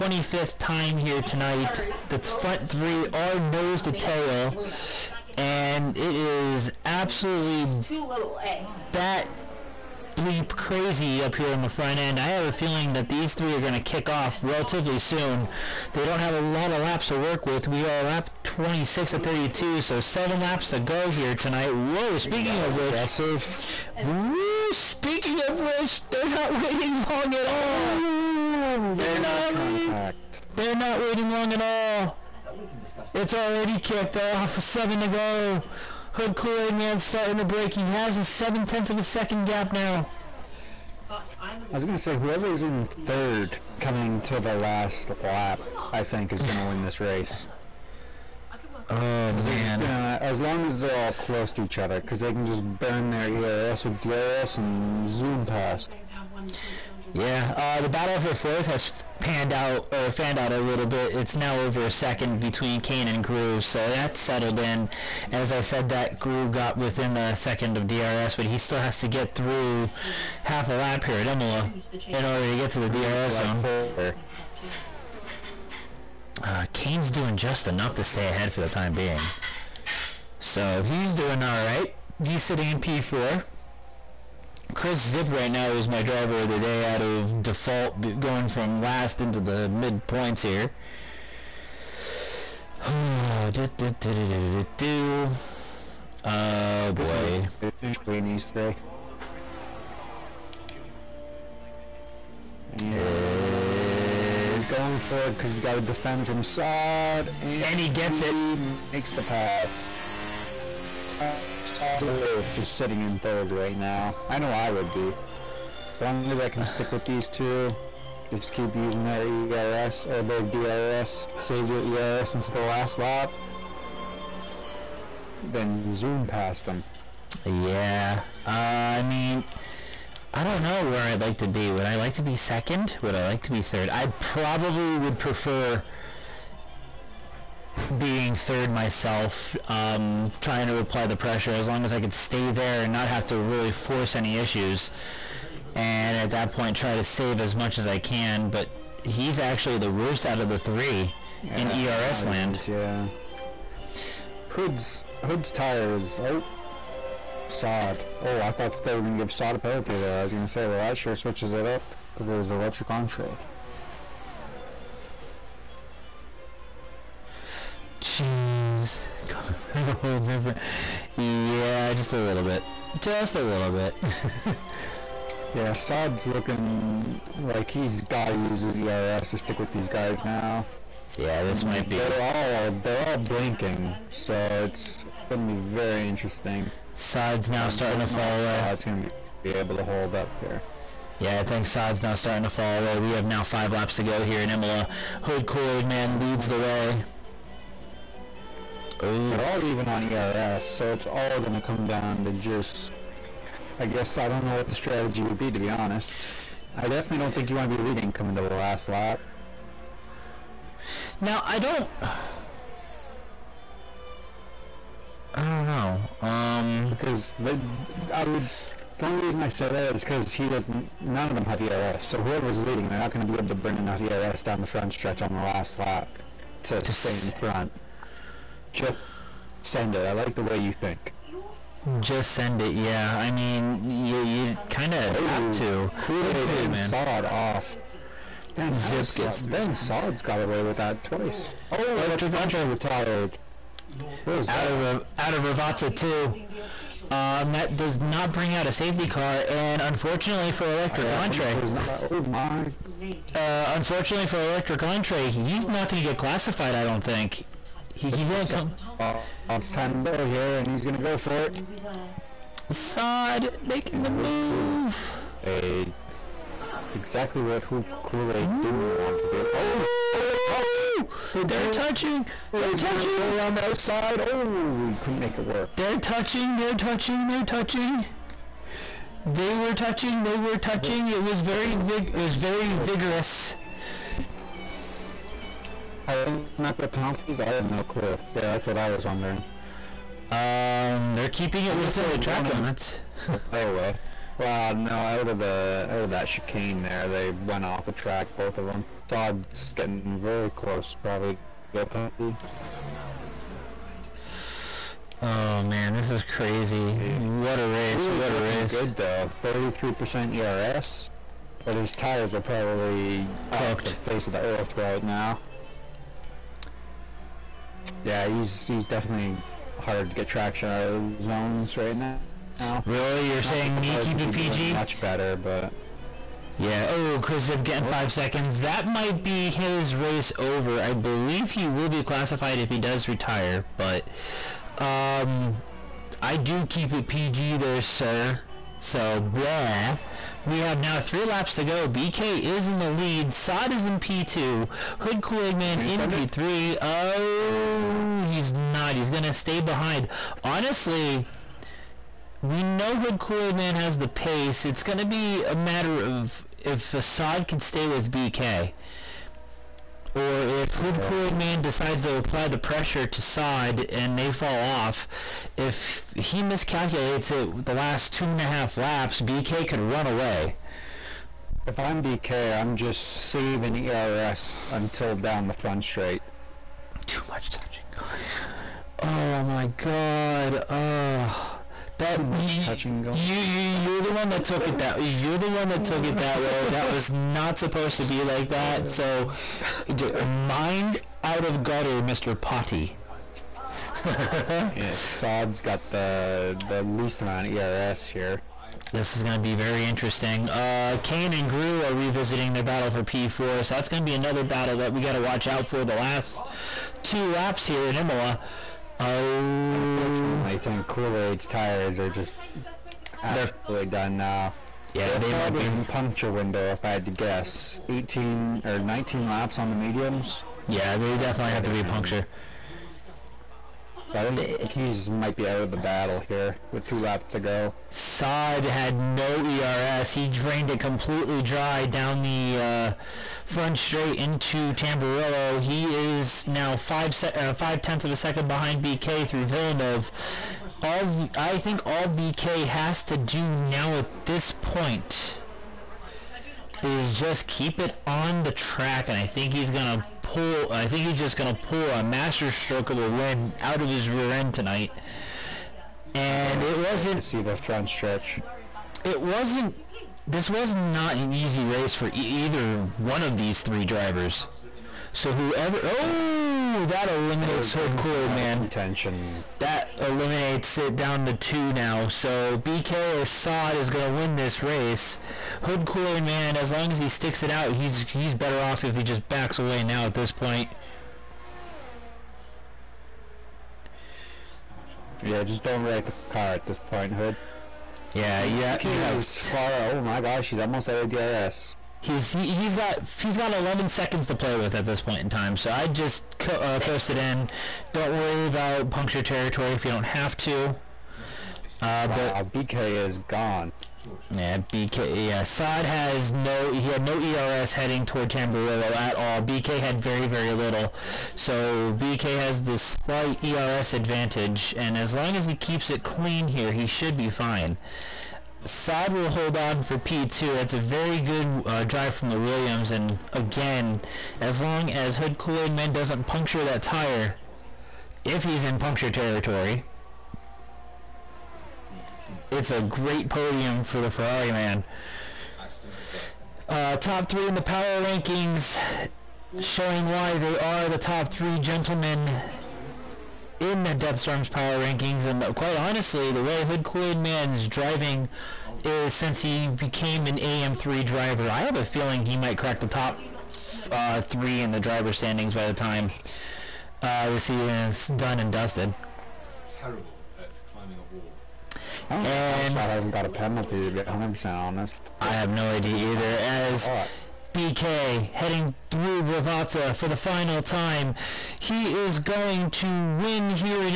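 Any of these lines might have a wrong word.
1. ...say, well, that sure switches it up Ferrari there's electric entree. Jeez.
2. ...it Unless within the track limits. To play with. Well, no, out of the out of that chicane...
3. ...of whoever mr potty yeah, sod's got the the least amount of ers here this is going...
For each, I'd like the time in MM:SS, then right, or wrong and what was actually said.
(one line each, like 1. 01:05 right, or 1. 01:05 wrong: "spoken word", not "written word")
1. 02:40 wrong: "But", not "Ferrari"
2. 04:51 right
3. 06:31 wrong: "gutter", not "whoever".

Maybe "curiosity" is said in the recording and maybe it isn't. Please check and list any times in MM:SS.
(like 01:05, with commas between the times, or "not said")
not said.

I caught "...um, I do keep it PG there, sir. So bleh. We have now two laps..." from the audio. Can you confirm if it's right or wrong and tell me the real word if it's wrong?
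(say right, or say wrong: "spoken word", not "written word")
wrong: "three", not "two".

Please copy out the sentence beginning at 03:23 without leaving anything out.
I guess I don't know what the strategy would be, to be honest.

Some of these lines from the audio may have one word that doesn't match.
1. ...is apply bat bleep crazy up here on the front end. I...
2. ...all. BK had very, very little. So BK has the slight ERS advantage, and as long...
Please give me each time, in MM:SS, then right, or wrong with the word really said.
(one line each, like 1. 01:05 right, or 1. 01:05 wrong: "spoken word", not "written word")
1. 00:06 wrong: "absolutely", not "apply"
2. 08:29 right.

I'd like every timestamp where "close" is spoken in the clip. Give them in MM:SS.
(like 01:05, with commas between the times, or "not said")
00:51, 05:00.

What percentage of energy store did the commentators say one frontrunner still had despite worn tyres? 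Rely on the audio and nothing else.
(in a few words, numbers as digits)
33%.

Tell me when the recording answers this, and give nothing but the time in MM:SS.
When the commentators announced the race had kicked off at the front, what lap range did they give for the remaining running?
00:17.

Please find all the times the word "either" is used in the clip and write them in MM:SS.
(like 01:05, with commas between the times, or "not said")
07:42, 09:26.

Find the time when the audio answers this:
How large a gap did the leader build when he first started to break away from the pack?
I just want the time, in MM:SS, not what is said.
00:38.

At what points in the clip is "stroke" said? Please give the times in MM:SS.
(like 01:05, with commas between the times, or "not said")
07:32.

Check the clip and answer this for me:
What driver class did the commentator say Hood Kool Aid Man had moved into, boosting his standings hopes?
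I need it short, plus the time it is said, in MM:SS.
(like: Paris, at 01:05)
AM3, at 09:10.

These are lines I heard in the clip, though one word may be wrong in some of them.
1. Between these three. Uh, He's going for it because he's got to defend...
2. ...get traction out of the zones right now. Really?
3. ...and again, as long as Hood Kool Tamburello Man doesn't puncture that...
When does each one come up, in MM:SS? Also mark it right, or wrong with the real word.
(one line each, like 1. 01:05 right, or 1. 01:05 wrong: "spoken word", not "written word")
1. 01:37 right
2. 05:20 right
3. 08:42 wrong: "Aid", not "Tamburello".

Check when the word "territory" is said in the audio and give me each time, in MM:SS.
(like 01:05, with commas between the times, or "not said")
08:19, 08:49.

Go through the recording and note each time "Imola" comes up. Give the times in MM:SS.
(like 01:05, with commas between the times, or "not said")
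01:11, 03:14, 06:47.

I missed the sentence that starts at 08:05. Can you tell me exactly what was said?
Yeah, just don't wreck the car at this point, Hood.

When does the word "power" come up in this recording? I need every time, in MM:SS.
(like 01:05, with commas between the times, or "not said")
08:57, 09:04.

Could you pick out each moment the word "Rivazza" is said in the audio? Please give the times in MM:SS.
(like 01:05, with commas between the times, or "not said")
04:05, 09:29.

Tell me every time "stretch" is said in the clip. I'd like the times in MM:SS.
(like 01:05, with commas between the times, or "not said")
03:44, 07:37.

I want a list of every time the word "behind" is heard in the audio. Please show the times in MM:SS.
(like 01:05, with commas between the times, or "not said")
05:49, 07:18.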